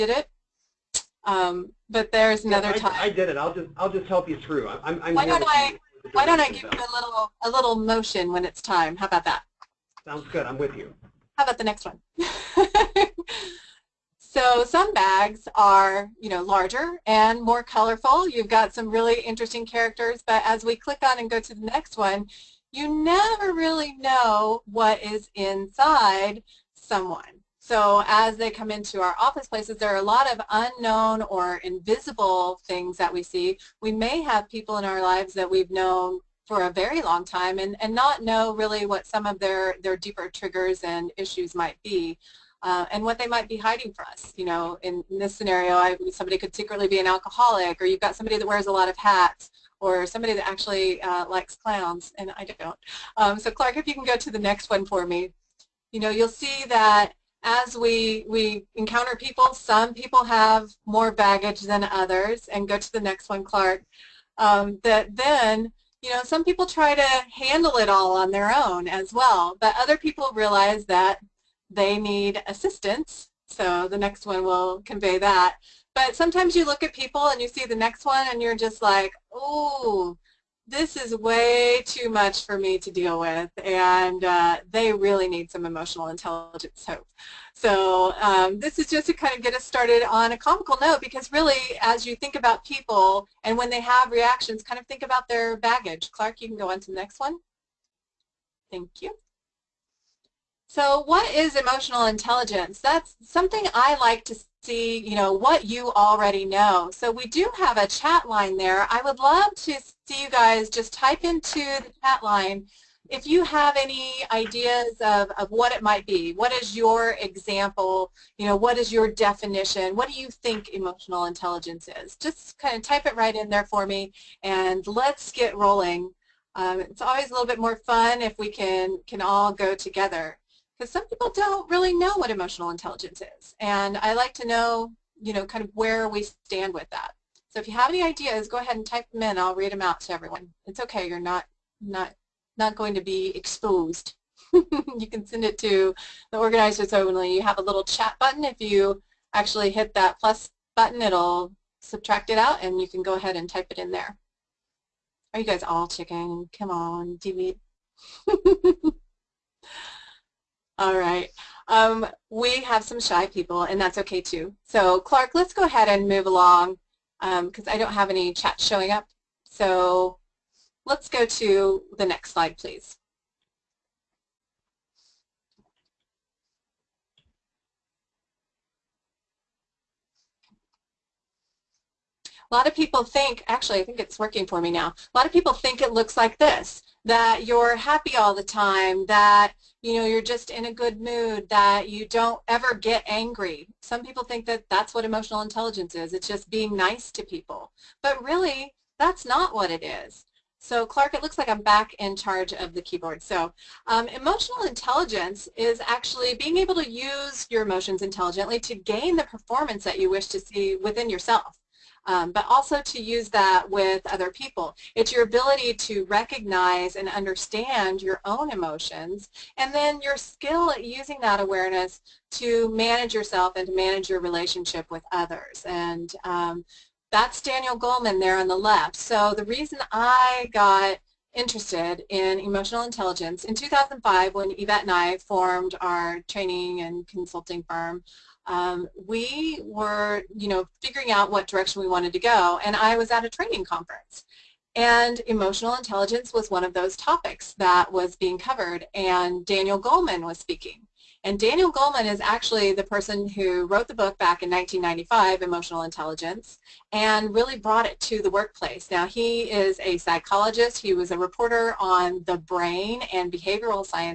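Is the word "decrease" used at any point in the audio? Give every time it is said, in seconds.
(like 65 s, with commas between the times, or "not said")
not said.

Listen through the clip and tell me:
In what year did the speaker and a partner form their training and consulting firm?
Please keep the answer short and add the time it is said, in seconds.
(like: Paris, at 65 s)
2005, at 233 s.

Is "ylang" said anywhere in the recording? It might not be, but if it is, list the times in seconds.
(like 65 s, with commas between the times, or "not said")
not said.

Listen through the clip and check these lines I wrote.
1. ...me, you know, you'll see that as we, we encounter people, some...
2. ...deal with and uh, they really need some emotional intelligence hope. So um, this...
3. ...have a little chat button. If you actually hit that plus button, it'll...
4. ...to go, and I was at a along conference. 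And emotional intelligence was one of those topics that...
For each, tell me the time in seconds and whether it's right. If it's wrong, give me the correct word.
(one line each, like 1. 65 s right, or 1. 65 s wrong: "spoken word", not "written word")
1. 55 s right
2. 82 s right
3. 147 s right
4. 242 s wrong: "training", not "along".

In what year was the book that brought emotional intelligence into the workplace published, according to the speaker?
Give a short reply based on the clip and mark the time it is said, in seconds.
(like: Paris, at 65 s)
1995, at 254 s.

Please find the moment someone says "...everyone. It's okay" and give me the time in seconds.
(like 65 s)
140 s.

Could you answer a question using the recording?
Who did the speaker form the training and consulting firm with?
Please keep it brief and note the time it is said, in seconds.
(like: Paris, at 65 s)
Yvette, at 234 s.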